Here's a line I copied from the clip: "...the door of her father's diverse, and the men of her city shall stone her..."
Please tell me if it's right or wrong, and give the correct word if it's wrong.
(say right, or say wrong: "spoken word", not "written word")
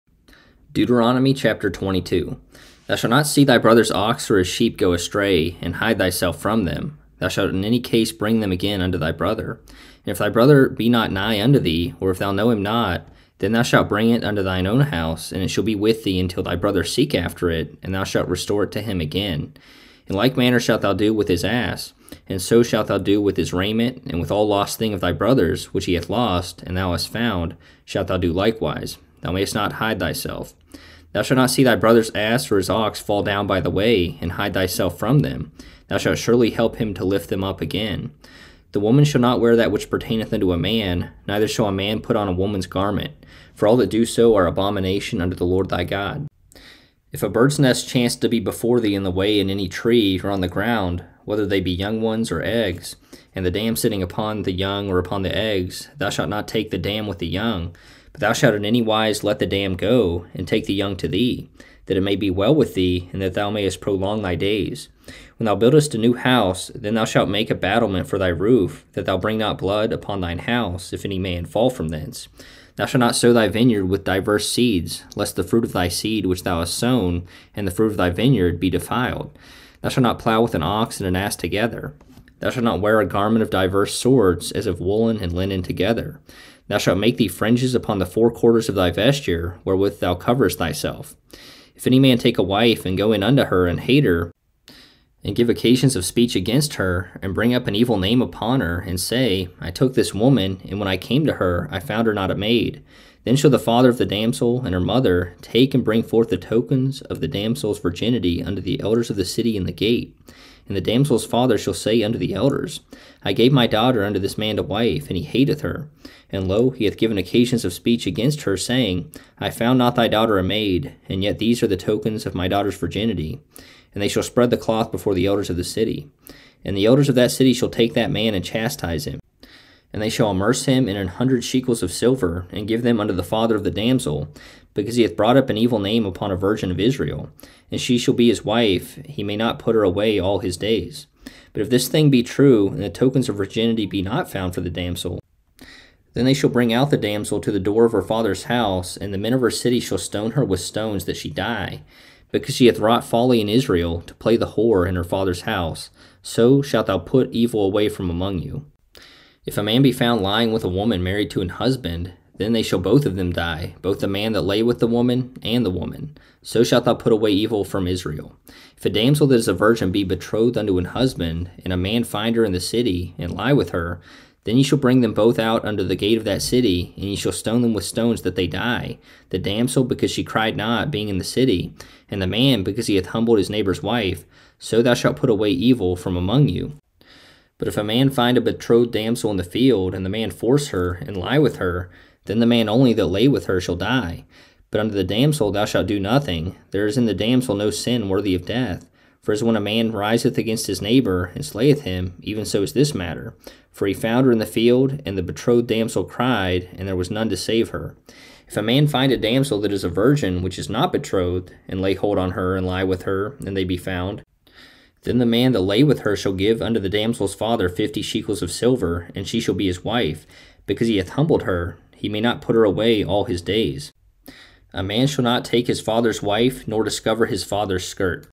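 wrong: "house", not "diverse".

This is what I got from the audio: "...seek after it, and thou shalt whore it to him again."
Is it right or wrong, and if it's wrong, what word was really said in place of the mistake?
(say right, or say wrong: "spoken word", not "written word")
wrong: "restore", not "whore".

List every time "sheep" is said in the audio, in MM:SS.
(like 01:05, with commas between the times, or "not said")
00:04.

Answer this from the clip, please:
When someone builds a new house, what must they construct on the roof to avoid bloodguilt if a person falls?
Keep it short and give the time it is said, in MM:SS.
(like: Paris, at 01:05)
A battlement, at 01:07.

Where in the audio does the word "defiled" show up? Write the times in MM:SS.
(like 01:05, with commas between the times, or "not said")
01:18.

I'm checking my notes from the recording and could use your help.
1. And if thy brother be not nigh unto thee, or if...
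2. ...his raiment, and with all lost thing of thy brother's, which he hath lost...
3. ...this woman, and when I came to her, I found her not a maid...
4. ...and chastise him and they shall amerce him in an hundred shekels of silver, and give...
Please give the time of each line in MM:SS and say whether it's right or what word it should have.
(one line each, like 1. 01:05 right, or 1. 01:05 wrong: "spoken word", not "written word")
1. 00:09 right
2. 00:23 right
3. 01:39 right
4. 02:08 right.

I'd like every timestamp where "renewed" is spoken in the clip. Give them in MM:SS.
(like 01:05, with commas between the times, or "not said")
not said.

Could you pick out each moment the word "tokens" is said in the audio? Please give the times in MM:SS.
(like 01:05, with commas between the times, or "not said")
01:46, 02:01, 02:22.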